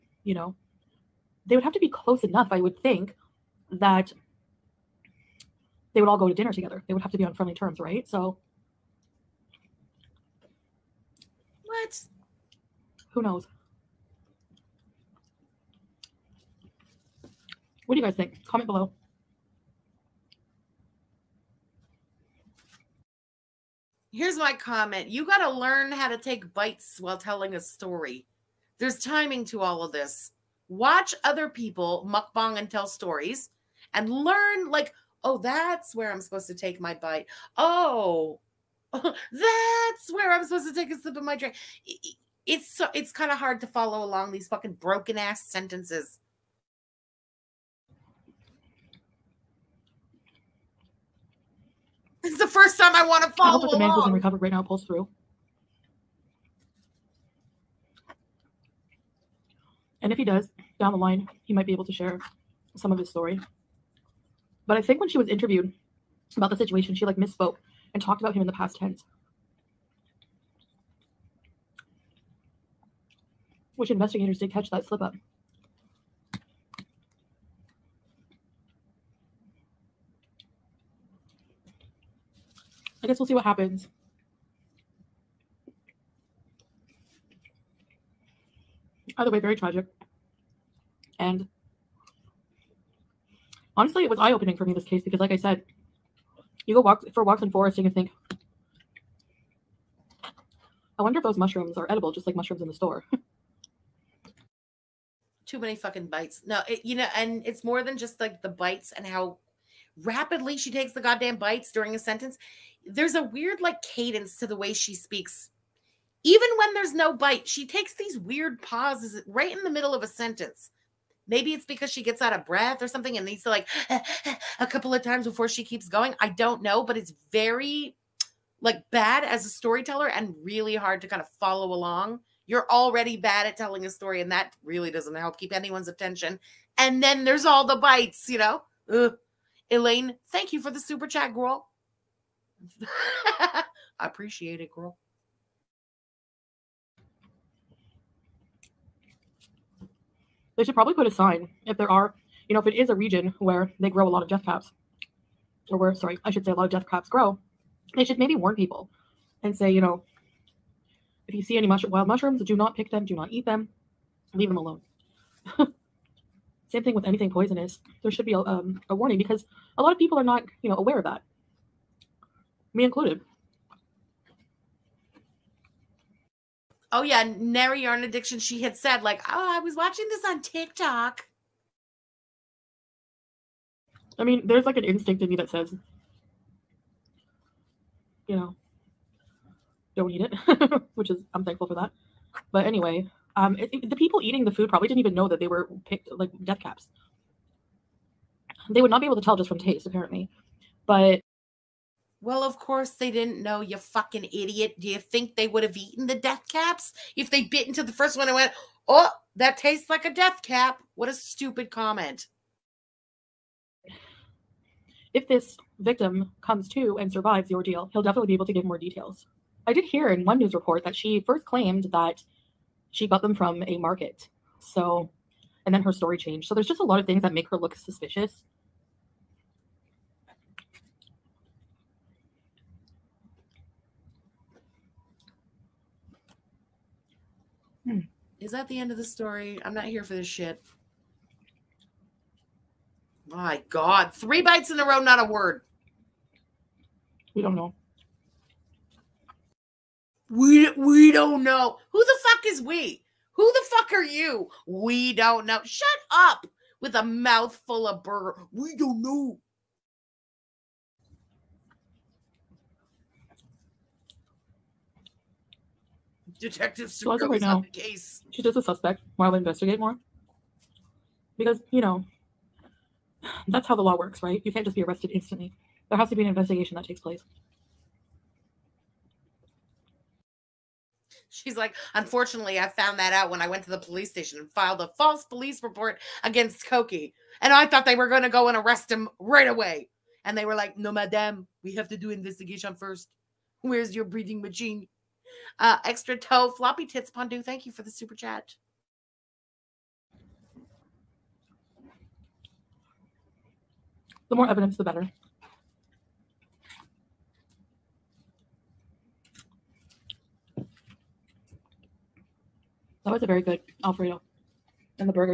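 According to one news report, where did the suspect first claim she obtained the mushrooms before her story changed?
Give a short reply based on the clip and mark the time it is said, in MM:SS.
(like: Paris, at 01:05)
a market, at 03:43.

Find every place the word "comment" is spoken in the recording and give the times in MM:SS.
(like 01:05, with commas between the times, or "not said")
00:18, 00:24, 03:31.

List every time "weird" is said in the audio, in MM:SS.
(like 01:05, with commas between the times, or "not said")
01:53, 01:58.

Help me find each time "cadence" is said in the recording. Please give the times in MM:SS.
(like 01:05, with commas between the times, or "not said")
01:53.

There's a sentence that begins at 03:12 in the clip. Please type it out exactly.
But anyway, um, it, it, the people eating the food probably didn't even know that they were picked like death caps.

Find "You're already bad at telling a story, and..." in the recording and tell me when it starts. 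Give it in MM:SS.
02:12.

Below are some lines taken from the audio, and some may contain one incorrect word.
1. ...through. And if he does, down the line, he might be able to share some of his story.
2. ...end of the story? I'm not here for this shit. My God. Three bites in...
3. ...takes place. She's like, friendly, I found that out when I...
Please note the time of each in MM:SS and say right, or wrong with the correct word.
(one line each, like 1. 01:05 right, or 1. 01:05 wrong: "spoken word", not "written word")
1. 00:54 right
2. 03:58 right
3. 04:36 wrong: "unfortunately", not "friendly".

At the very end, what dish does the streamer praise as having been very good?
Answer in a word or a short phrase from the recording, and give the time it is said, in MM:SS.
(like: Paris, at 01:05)
Alfredo, at 05:13.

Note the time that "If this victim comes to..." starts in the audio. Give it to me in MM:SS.
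03:35.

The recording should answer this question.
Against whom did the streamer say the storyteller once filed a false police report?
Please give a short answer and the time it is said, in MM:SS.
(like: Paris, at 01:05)
Koki, at 04:46.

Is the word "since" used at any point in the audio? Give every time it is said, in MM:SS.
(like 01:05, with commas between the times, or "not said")
not said.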